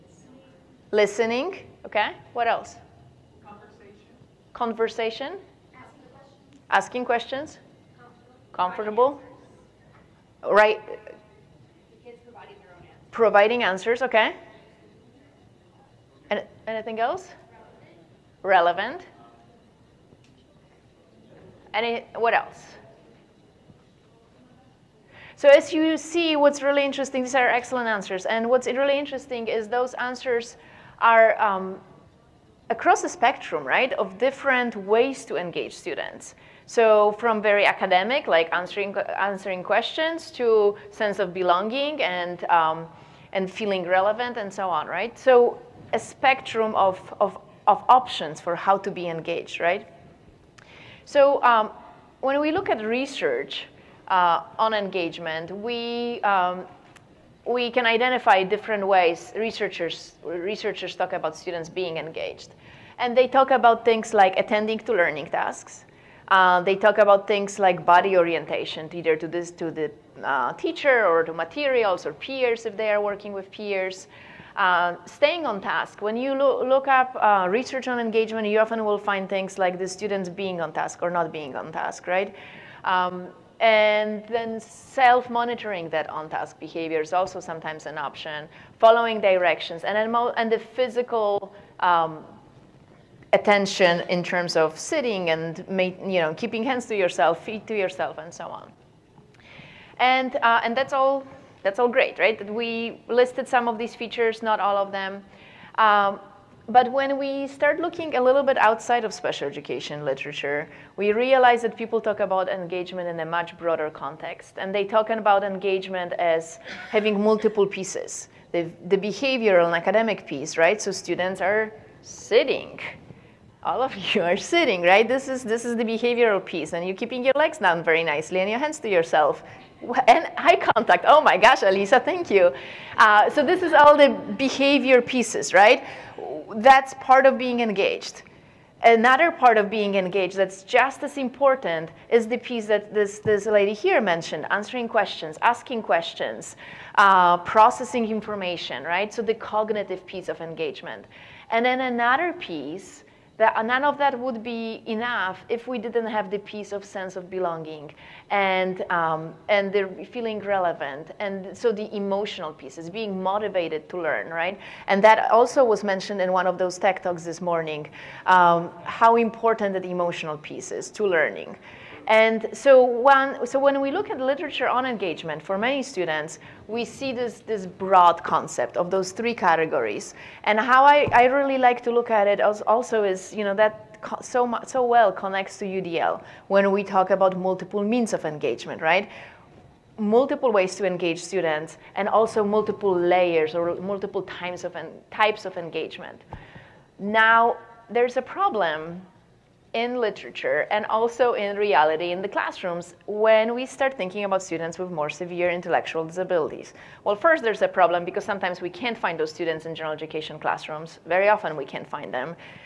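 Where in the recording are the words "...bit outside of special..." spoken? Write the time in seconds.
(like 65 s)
108 s.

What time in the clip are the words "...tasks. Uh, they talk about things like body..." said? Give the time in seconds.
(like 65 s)
65 s.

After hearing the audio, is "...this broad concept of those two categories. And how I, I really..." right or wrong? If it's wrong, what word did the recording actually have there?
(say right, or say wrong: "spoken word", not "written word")
wrong: "three", not "two".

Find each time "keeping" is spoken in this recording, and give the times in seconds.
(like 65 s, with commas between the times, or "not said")
96 s, 126 s.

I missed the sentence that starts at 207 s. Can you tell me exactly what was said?
Well, first, there's a problem because sometimes we can't find those students in general education classrooms.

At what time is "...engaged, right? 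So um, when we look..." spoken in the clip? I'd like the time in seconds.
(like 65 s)
49 s.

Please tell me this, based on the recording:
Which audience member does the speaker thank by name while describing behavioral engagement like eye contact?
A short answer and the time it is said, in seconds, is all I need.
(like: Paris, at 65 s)
Alisa, at 131 s.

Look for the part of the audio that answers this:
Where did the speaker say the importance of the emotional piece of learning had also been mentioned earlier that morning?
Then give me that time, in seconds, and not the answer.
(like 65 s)
166 s.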